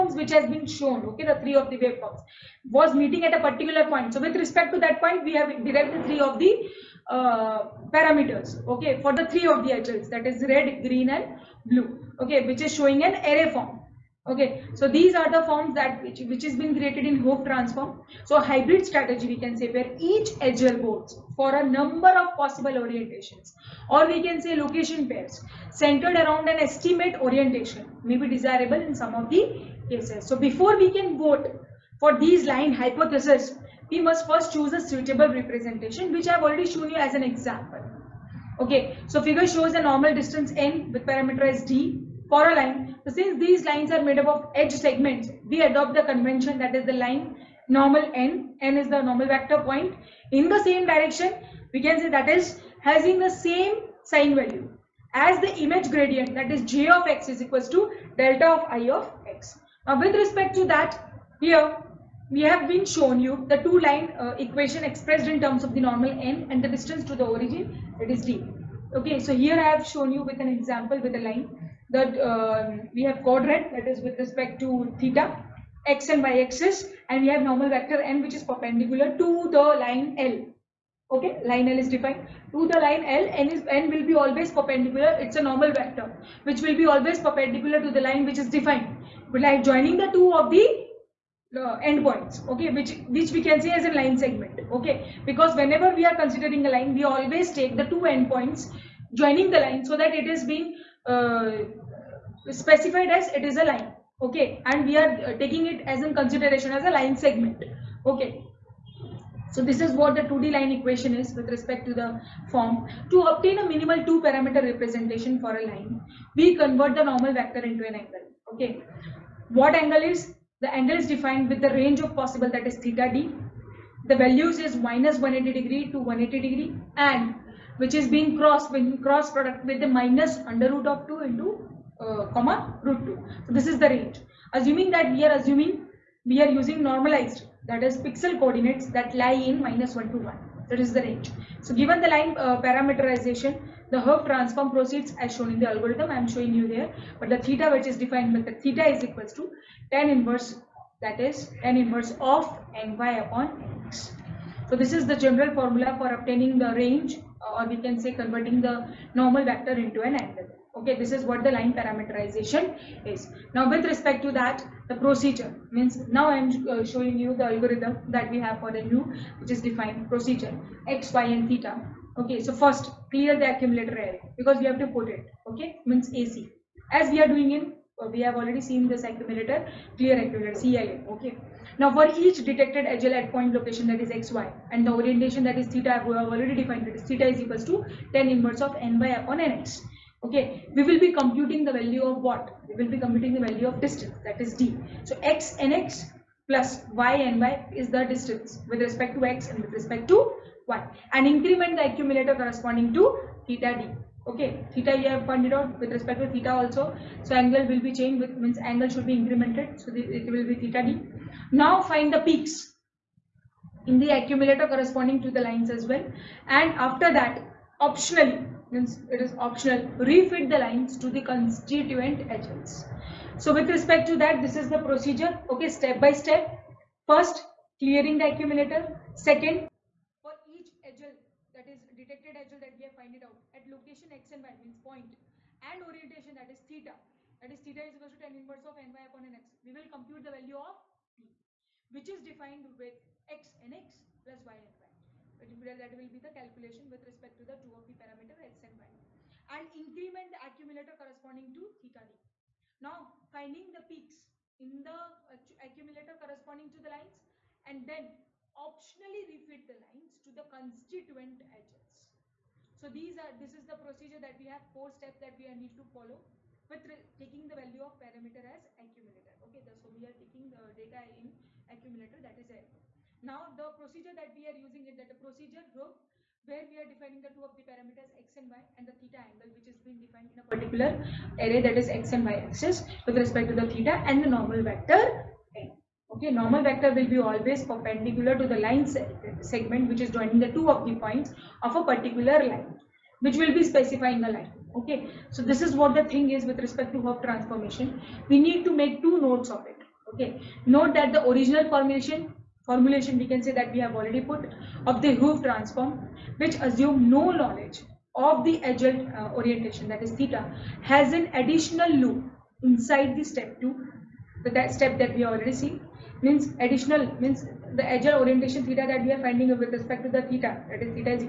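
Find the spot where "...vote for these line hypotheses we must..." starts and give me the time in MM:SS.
00:31.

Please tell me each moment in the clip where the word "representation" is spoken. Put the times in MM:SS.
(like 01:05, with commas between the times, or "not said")
00:35, 01:54.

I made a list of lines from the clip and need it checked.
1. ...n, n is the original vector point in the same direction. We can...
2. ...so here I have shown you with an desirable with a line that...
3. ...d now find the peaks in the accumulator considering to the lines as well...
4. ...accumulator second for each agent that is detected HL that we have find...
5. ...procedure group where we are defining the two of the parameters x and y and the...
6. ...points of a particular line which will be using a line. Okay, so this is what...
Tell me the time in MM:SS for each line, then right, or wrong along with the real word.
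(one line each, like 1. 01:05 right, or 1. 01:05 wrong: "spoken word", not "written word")
1. 00:48 wrong: "normal", not "original"
2. 01:09 wrong: "example", not "desirable"
3. 03:30 wrong: "corresponding", not "considering"
4. 03:48 right
5. 04:35 right
6. 04:51 wrong: "specifying", not "using".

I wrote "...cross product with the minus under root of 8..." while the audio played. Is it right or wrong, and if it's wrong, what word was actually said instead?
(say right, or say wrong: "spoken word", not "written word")
wrong: "2", not "8".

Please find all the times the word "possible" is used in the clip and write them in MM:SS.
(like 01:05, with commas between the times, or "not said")
00:22, 02:02.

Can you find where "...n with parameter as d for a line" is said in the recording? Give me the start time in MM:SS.
00:40.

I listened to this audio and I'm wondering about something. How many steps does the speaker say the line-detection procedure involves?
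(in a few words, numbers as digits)
4.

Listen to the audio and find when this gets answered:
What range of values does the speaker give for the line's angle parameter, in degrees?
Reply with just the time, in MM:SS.
02:04.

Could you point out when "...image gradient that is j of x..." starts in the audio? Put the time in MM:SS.
00:55.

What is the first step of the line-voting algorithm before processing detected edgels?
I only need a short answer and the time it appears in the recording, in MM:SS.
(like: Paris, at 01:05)
Clear the accumulator array, at 02:53.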